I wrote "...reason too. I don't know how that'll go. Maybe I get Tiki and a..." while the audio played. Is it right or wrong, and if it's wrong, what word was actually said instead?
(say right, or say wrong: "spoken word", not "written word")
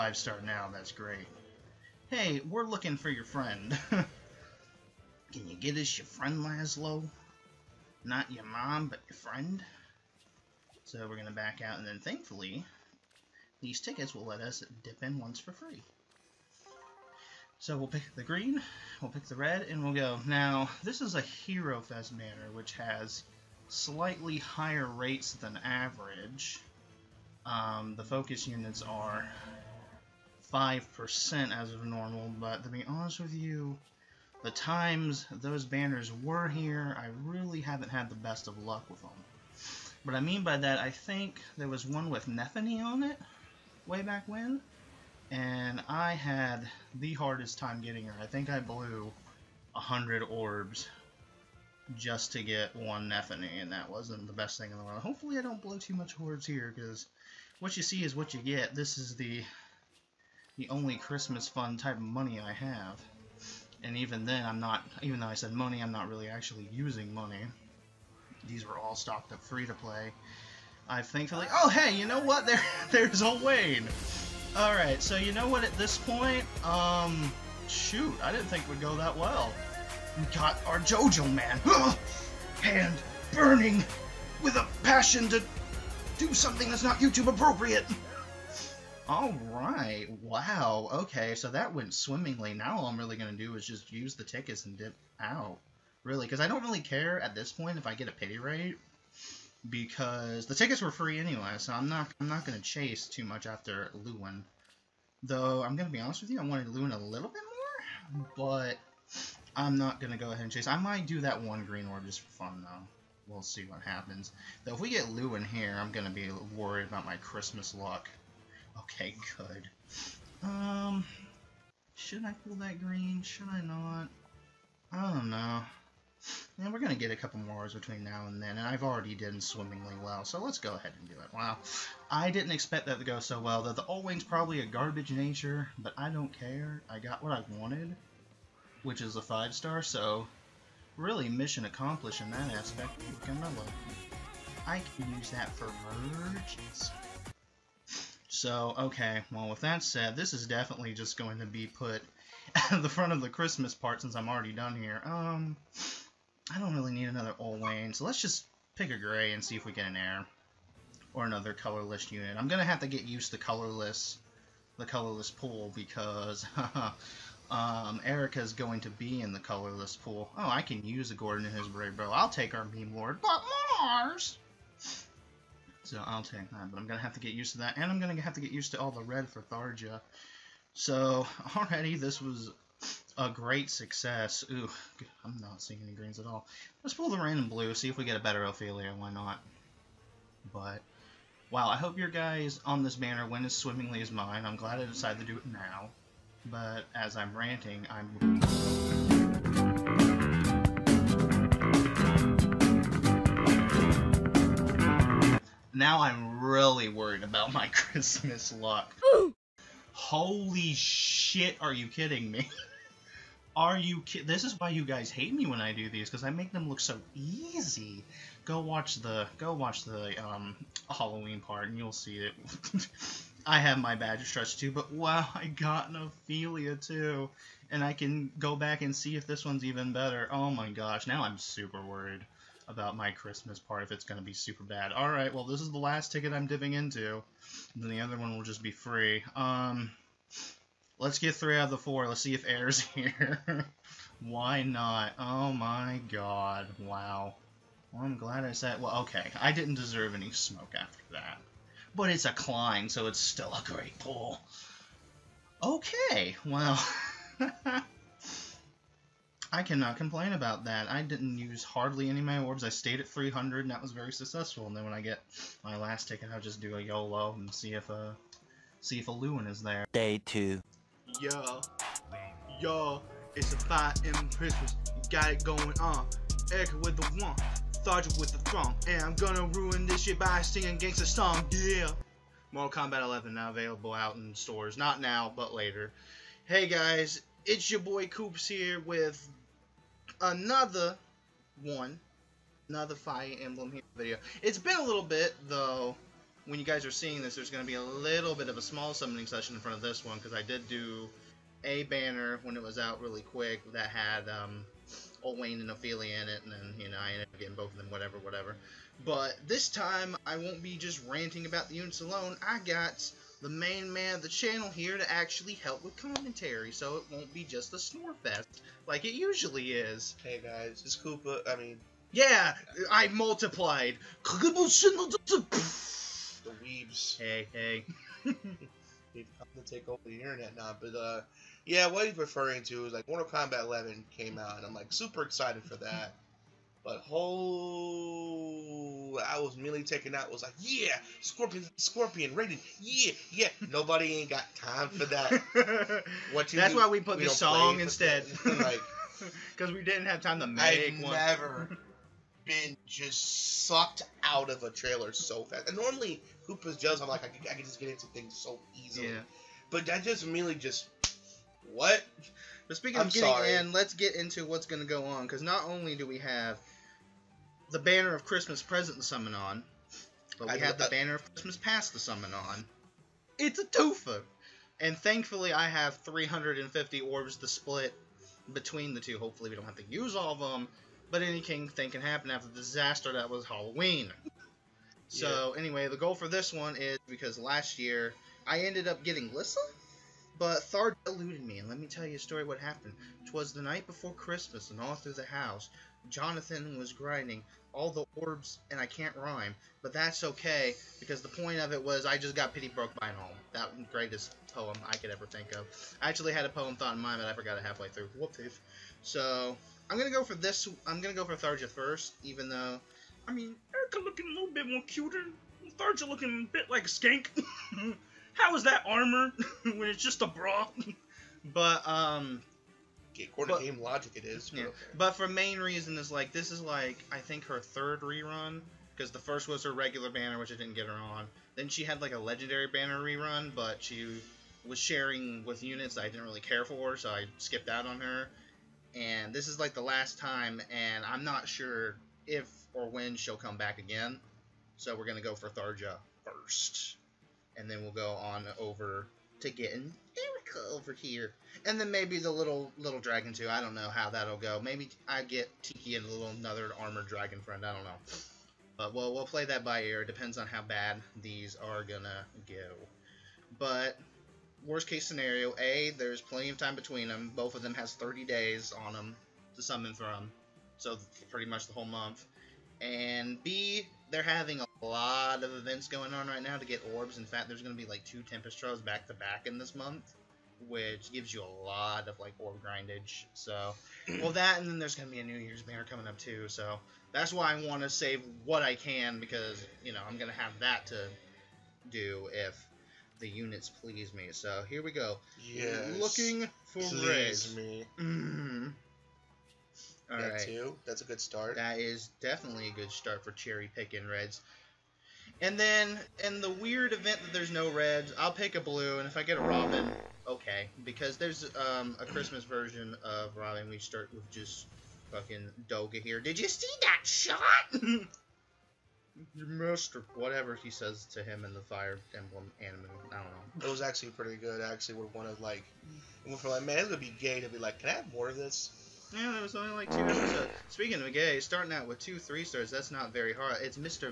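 wrong: "dragon", not "reason".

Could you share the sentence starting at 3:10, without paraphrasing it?
But, wow, I hope your guys on this banner went as swimmingly as mine.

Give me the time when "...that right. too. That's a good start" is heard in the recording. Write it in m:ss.
8:20.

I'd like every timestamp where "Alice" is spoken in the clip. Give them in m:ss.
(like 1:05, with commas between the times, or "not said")
not said.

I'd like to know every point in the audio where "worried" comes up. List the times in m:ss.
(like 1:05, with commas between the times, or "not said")
1:56, 3:26, 3:51.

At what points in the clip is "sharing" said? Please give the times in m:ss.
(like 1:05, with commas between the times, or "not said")
7:14.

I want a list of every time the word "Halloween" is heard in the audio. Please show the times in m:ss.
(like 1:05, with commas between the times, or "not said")
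3:40, 6:23.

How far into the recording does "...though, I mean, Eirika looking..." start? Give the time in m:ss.
6:52.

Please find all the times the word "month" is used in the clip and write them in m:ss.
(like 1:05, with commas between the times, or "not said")
7:51, 7:59.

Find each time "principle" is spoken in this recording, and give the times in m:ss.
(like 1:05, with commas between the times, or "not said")
not said.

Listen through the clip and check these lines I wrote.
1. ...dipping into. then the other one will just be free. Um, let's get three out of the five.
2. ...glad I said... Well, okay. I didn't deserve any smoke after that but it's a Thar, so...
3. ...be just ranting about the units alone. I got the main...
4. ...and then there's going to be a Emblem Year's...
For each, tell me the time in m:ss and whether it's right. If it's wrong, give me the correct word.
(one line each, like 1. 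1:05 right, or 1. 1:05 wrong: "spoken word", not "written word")
1. 3:56 wrong: "four", not "five"
2. 4:08 wrong: "Klein", not "Thar"
3. 5:10 right
4. 8:04 wrong: "New", not "Emblem".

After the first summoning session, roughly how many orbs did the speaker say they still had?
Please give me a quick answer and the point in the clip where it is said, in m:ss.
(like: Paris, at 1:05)
300, at 4:23.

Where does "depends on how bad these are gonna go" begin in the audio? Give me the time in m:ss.
7:40.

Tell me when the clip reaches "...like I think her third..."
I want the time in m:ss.
7:06.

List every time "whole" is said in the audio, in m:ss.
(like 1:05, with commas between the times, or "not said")
5:37, 7:51.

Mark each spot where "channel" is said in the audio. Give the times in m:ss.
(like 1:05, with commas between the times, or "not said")
5:14.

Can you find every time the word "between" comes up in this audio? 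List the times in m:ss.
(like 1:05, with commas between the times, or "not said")
2:07, 6:18, 7:46.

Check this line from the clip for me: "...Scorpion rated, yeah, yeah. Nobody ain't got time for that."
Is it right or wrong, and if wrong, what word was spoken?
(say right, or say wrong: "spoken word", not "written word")
right.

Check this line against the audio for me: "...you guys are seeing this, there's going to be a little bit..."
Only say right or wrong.
right.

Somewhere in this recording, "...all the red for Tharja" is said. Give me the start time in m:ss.
2:58.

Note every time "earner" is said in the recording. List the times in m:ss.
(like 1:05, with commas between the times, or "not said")
not said.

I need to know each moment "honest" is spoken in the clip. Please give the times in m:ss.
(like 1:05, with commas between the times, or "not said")
0:32, 1:45.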